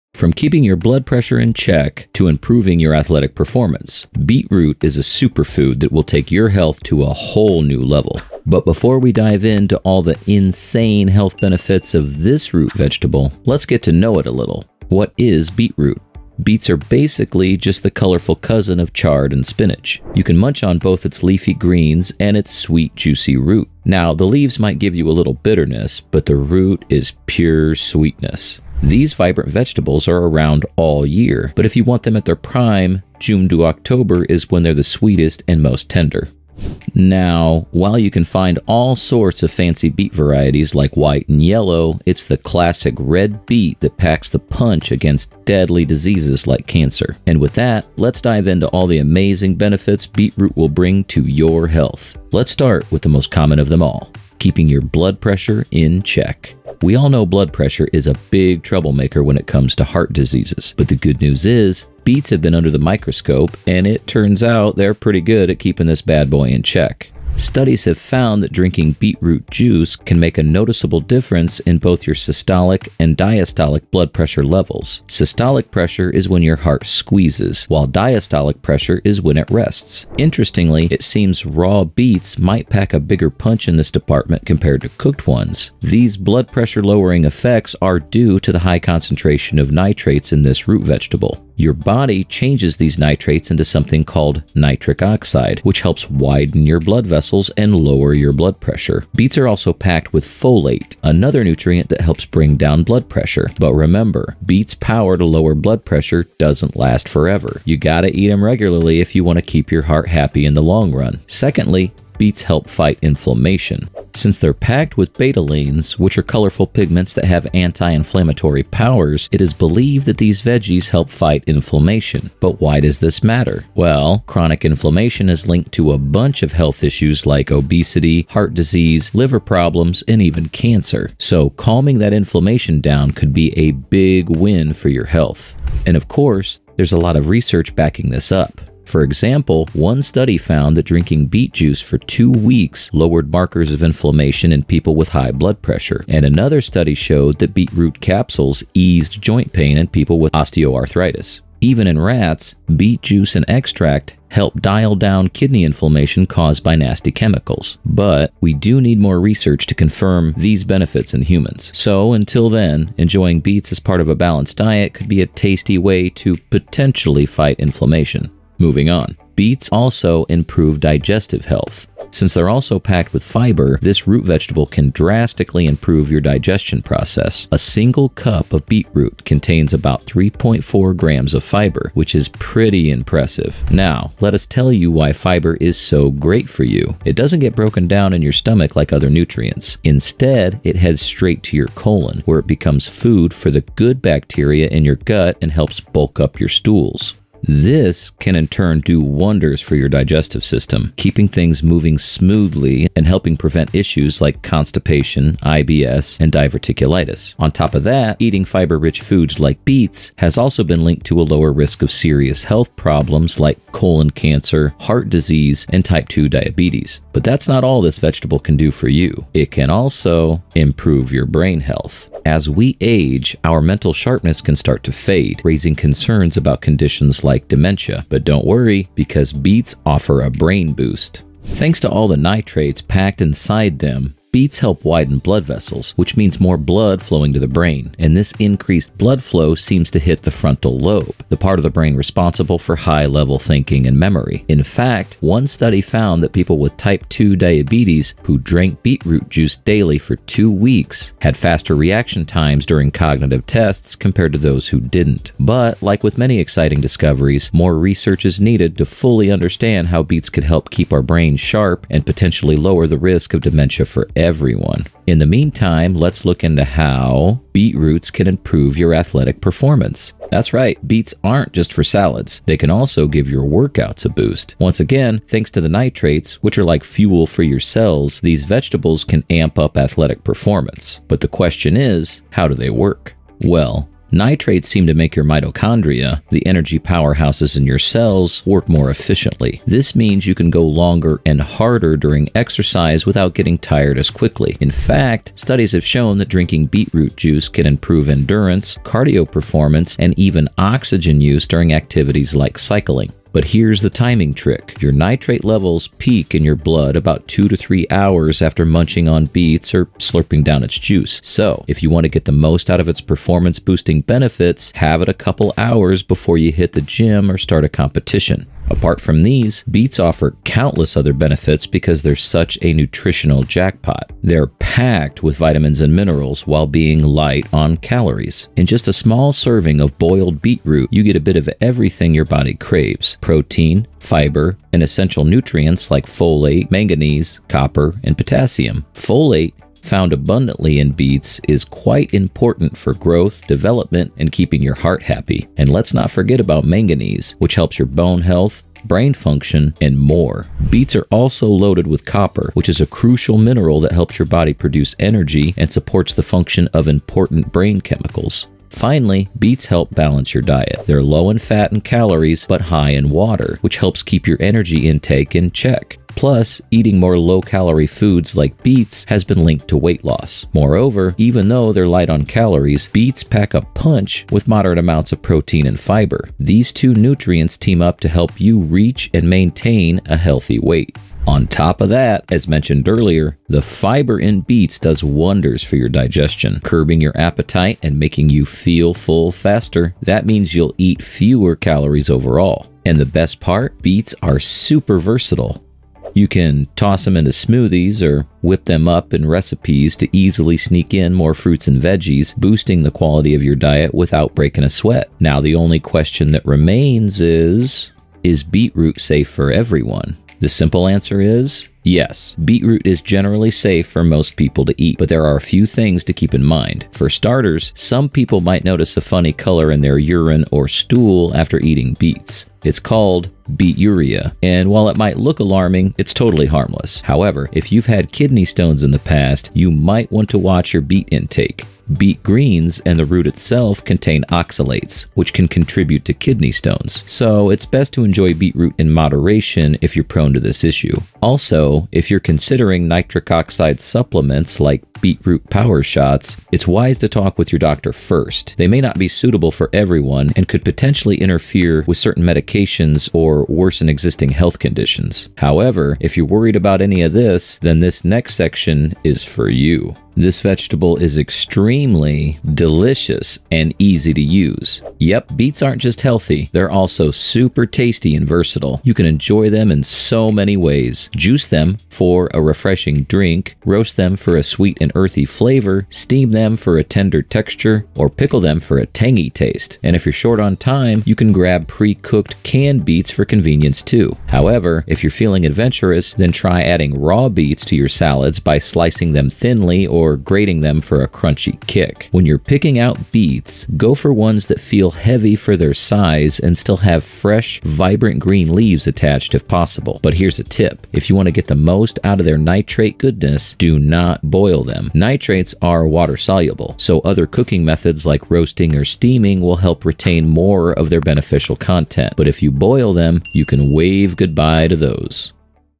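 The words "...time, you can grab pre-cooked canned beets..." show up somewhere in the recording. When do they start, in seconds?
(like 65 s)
480 s.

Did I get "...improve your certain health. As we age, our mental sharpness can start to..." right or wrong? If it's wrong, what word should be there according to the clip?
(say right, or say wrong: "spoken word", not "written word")
wrong: "brain", not "certain".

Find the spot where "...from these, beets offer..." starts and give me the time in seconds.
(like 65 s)
319 s.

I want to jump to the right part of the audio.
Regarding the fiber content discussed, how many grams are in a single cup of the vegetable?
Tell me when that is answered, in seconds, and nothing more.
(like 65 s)
180 s.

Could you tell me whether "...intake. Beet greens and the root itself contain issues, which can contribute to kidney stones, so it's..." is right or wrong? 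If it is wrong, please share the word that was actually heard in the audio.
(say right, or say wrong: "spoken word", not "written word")
wrong: "oxalates", not "issues".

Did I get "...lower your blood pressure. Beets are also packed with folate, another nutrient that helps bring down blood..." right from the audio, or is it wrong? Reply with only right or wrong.
right.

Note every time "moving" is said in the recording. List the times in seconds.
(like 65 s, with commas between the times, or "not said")
168 s, 201 s.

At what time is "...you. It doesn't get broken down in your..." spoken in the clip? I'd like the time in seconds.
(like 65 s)
186 s.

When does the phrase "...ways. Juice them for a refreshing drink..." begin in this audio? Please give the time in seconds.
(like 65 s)
470 s.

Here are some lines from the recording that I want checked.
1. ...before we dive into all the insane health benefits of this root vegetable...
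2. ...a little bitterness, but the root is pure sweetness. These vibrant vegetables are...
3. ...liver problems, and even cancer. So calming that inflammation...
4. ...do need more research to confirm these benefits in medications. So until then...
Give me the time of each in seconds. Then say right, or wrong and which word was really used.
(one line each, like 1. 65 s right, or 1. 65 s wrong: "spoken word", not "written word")
1. 8 s right
2. 25 s right
3. 129 s right
4. 158 s wrong: "humans", not "medications".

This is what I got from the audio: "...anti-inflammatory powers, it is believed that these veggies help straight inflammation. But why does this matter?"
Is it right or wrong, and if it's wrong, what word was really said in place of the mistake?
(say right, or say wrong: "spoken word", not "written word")
wrong: "fight", not "straight".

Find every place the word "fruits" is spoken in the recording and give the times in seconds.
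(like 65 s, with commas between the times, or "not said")
401 s.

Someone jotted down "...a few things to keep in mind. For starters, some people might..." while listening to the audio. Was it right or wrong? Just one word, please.
right.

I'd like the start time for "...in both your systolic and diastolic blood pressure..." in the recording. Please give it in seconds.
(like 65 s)
71 s.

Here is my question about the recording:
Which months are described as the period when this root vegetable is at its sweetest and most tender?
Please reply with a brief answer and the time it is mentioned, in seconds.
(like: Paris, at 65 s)
June to October, at 33 s.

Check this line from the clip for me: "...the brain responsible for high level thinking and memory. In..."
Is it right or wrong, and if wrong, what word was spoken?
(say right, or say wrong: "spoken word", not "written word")
right.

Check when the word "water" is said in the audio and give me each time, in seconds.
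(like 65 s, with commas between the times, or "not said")
363 s, 505 s.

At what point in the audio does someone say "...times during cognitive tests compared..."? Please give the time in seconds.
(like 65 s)
252 s.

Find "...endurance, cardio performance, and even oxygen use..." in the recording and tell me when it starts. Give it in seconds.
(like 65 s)
298 s.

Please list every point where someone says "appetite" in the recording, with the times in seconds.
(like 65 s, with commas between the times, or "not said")
387 s.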